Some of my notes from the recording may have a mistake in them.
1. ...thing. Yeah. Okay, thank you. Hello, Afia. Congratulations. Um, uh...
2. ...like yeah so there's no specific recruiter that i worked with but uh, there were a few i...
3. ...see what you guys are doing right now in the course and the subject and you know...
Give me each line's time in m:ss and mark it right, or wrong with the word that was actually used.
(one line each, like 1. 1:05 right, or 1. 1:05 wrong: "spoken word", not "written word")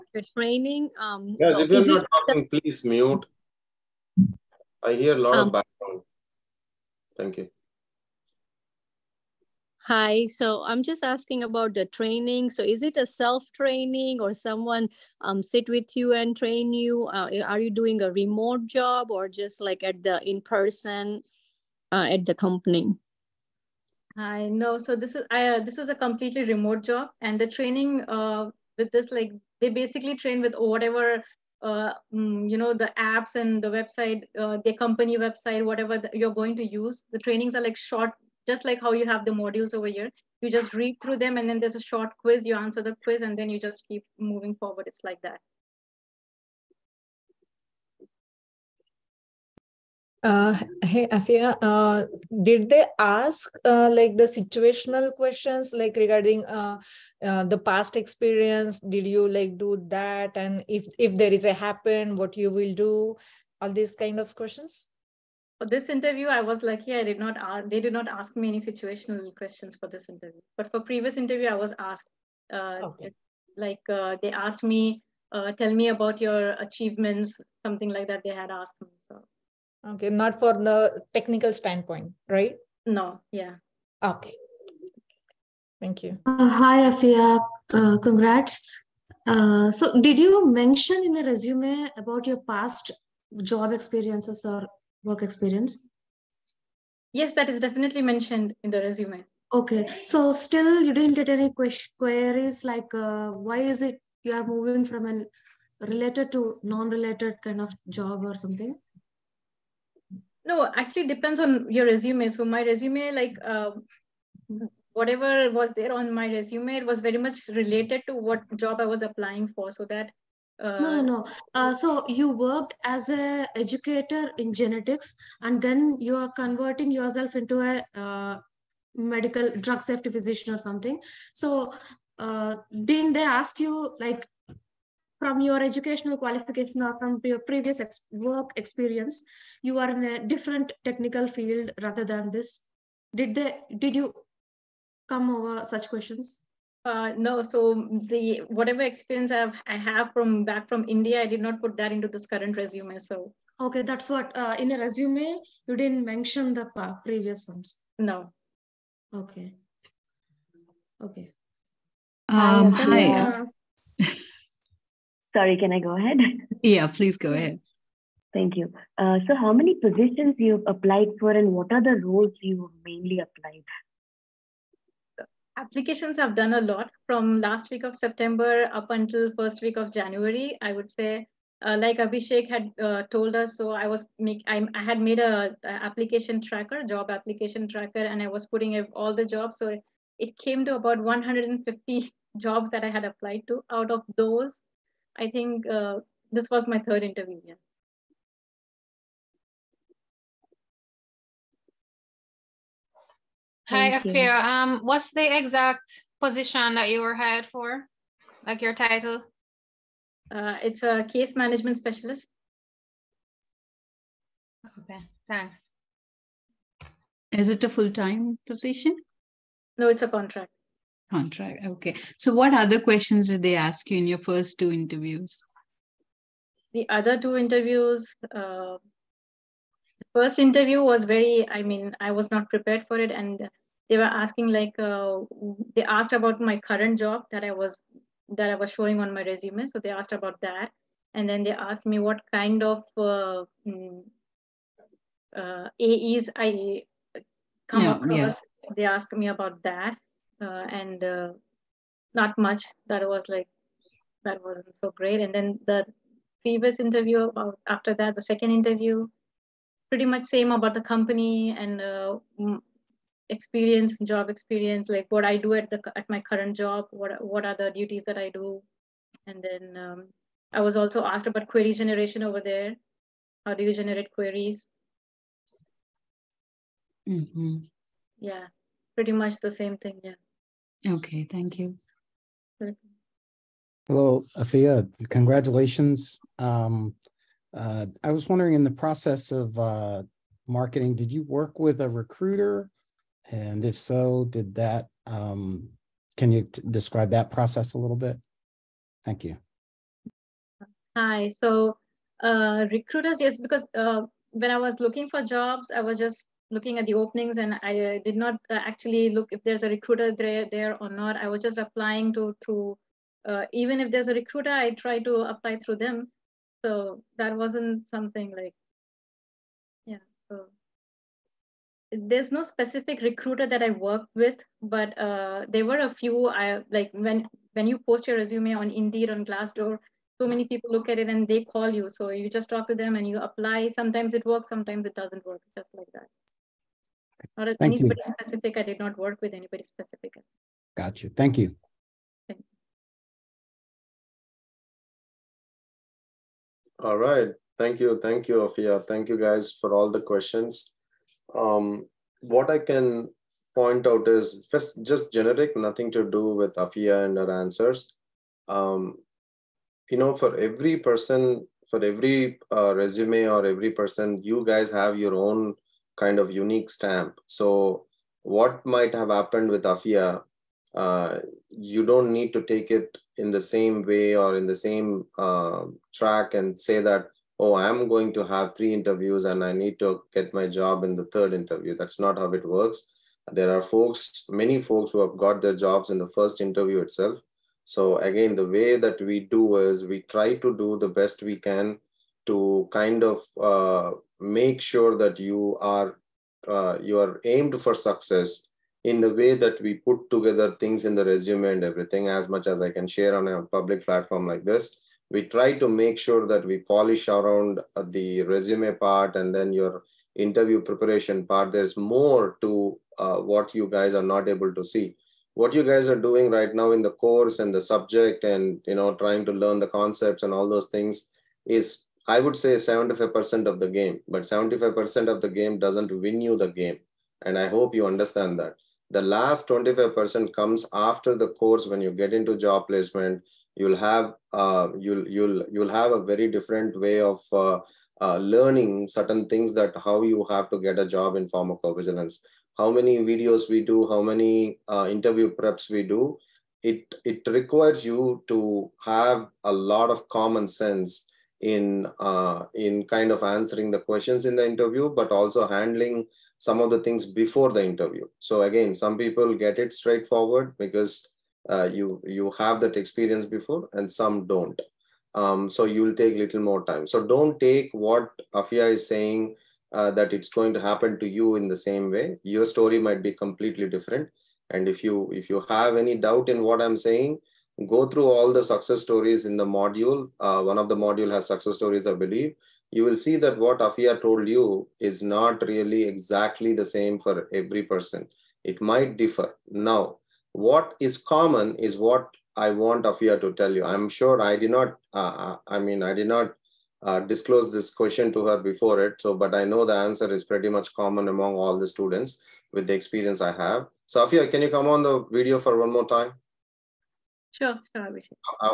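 1. 4:39 right
2. 5:18 right
3. 6:54 right.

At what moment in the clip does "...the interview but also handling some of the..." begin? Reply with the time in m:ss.
7:34.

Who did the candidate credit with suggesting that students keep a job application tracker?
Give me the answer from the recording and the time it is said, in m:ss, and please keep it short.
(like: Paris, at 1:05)
Abhishek, at 3:01.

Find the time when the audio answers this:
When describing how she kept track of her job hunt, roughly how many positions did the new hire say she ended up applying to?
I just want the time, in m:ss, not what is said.
3:10.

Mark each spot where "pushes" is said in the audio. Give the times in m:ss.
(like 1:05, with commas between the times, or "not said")
not said.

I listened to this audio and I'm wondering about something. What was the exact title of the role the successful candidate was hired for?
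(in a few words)
Case management specialist.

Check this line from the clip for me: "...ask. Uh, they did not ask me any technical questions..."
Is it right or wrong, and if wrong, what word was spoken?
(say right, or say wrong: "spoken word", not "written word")
wrong: "situational", not "technical".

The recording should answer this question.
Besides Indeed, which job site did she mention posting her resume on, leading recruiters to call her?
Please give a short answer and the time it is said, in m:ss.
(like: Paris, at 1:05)
Glassdoor, at 5:29.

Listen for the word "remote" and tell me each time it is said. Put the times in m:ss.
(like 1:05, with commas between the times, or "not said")
0:18, 0:26.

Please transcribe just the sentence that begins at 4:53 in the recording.
And if so, did that, um, can you describe that process a little bit?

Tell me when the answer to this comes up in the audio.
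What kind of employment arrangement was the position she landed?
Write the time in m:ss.
3:39.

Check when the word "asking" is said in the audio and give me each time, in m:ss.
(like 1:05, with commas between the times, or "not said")
0:11, 3:54.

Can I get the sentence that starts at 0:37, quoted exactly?
The trainings are like short, just like how you have the modules over here.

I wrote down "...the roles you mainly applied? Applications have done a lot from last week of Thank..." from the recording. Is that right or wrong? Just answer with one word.
wrong.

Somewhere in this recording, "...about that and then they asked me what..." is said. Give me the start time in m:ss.
4:00.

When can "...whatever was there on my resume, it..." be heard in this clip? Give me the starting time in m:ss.
1:54.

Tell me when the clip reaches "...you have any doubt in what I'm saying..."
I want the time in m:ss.
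7:55.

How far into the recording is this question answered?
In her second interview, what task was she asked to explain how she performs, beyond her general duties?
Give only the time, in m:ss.
4:31.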